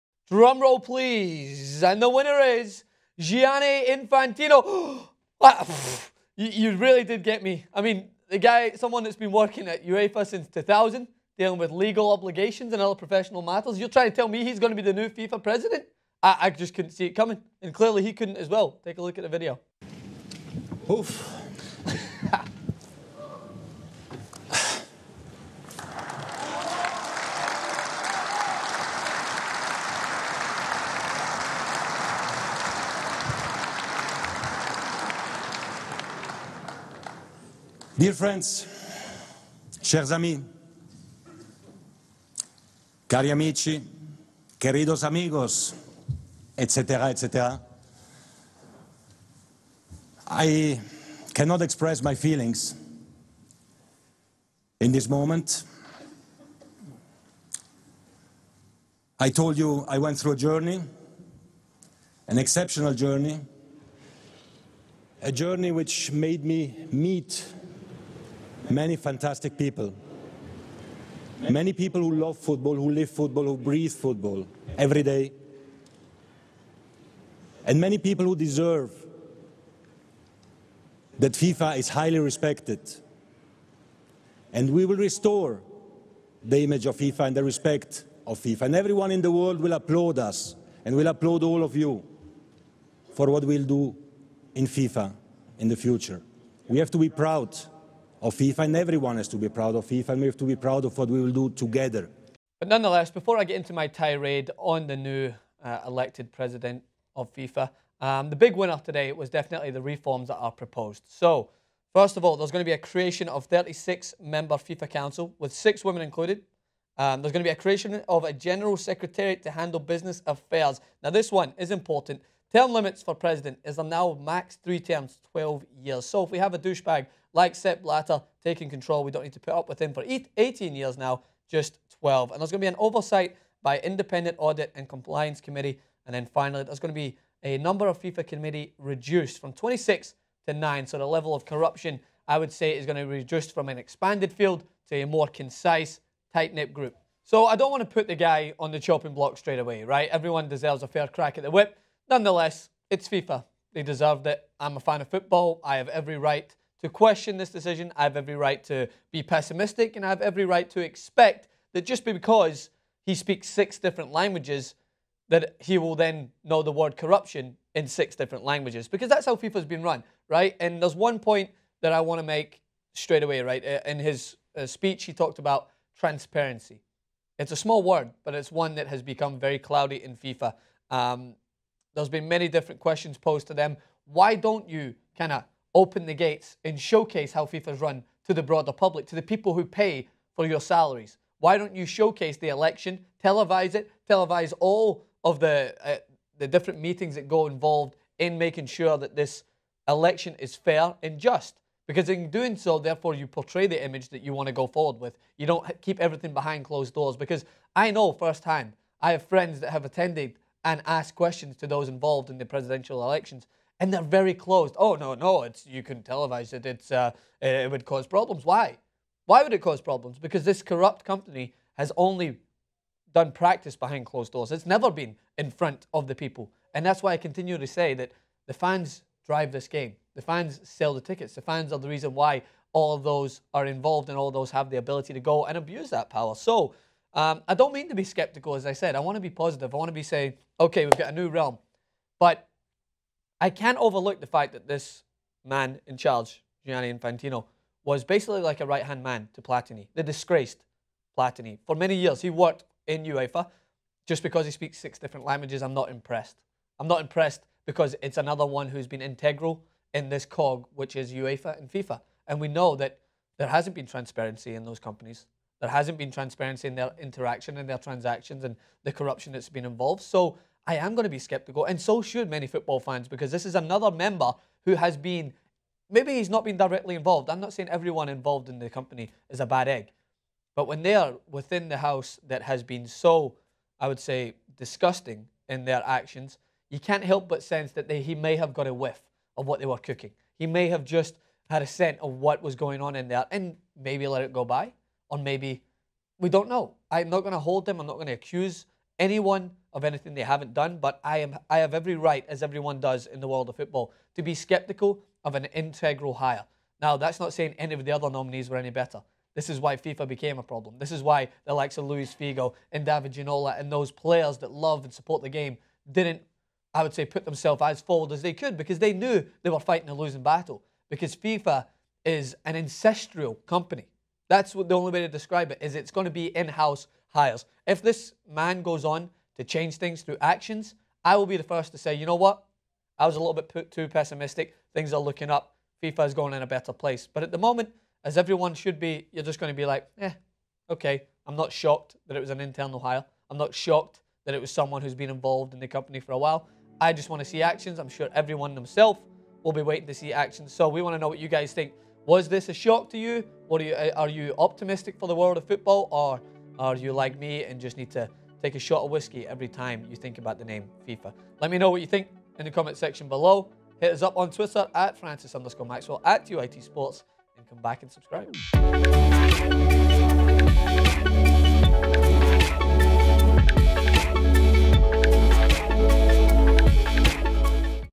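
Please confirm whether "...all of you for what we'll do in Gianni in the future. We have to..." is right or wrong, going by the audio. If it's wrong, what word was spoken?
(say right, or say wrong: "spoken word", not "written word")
wrong: "FIFA", not "Gianni".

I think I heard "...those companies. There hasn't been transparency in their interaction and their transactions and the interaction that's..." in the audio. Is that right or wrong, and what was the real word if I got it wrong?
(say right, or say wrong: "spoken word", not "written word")
wrong: "corruption", not "interaction".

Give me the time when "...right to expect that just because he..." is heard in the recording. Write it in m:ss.
2:40.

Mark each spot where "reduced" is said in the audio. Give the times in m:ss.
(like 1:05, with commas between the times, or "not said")
2:18, 2:23.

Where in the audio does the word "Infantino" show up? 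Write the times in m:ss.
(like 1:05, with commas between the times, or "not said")
0:03, 4:06.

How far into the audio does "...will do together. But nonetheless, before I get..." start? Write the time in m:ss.
1:41.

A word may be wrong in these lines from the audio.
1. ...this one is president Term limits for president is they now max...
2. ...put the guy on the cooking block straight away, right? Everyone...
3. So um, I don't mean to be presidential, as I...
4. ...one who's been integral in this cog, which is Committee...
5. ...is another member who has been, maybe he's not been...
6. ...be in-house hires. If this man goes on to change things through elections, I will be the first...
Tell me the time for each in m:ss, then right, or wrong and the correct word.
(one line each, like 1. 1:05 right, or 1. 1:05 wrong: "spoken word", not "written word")
1. 2:01 wrong: "important", not "president"
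2. 2:27 wrong: "chopping", not "cooking"
3. 3:56 wrong: "skeptical", not "presidential"
4. 4:18 wrong: "UEFA", not "Committee"
5. 4:33 right
6. 5:26 wrong: "actions", not "elections".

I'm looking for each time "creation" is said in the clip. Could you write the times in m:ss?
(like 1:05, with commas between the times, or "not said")
1:52, 1:57.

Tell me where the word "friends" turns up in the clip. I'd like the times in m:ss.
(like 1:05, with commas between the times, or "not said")
0:38, 3:29.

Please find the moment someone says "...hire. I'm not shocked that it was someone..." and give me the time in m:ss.
5:42.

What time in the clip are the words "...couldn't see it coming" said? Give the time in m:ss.
0:16.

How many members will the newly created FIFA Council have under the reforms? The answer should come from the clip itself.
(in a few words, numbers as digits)
36.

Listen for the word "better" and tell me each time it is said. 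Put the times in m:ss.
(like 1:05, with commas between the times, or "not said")
5:08, 5:36.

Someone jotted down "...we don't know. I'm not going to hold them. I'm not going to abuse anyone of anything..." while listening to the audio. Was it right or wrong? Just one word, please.
wrong.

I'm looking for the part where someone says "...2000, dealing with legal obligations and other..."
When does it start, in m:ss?
0:10.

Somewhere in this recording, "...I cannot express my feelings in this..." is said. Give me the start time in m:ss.
0:50.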